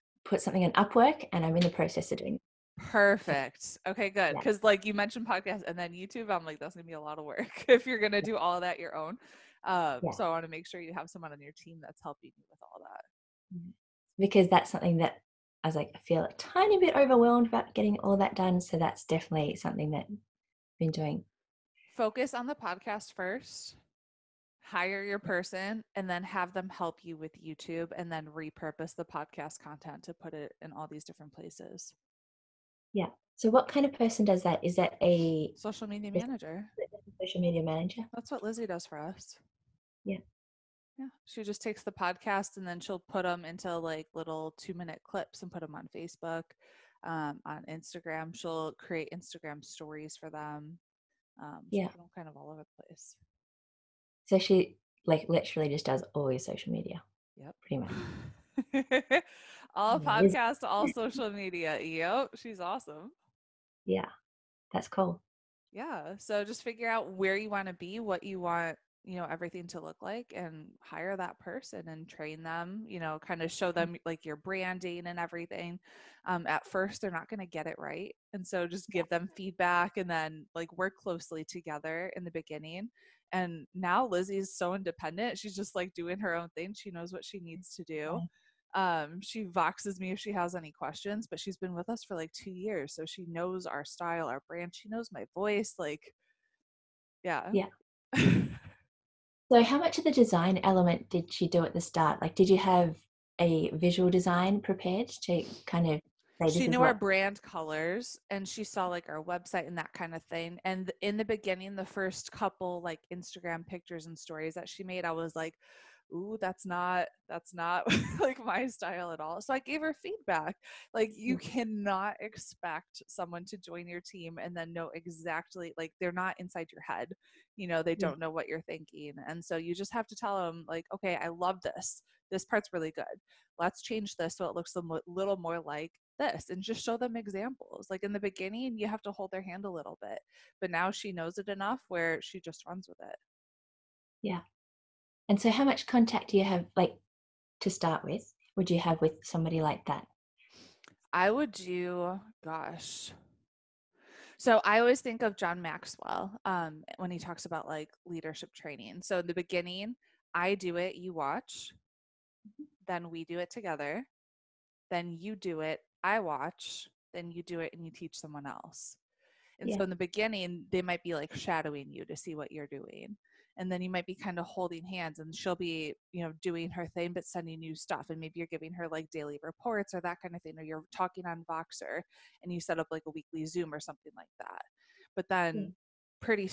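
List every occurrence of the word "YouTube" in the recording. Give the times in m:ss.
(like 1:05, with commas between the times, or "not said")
0:05, 0:27.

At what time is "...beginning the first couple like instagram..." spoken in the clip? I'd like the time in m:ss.
1:51.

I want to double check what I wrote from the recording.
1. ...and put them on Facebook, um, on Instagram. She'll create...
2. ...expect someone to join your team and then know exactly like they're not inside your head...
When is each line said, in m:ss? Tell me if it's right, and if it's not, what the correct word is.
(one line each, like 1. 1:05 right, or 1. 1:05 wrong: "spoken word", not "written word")
1. 0:45 right
2. 2:02 right.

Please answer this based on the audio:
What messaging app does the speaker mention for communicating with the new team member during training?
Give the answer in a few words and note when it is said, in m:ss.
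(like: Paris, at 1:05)
Voxer, at 3:01.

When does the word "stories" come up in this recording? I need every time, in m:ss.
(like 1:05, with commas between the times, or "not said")
0:49, 1:54.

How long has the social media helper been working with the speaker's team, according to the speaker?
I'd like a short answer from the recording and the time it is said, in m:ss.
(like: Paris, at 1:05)
2 years, at 1:32.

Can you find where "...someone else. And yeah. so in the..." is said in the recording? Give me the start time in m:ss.
2:48.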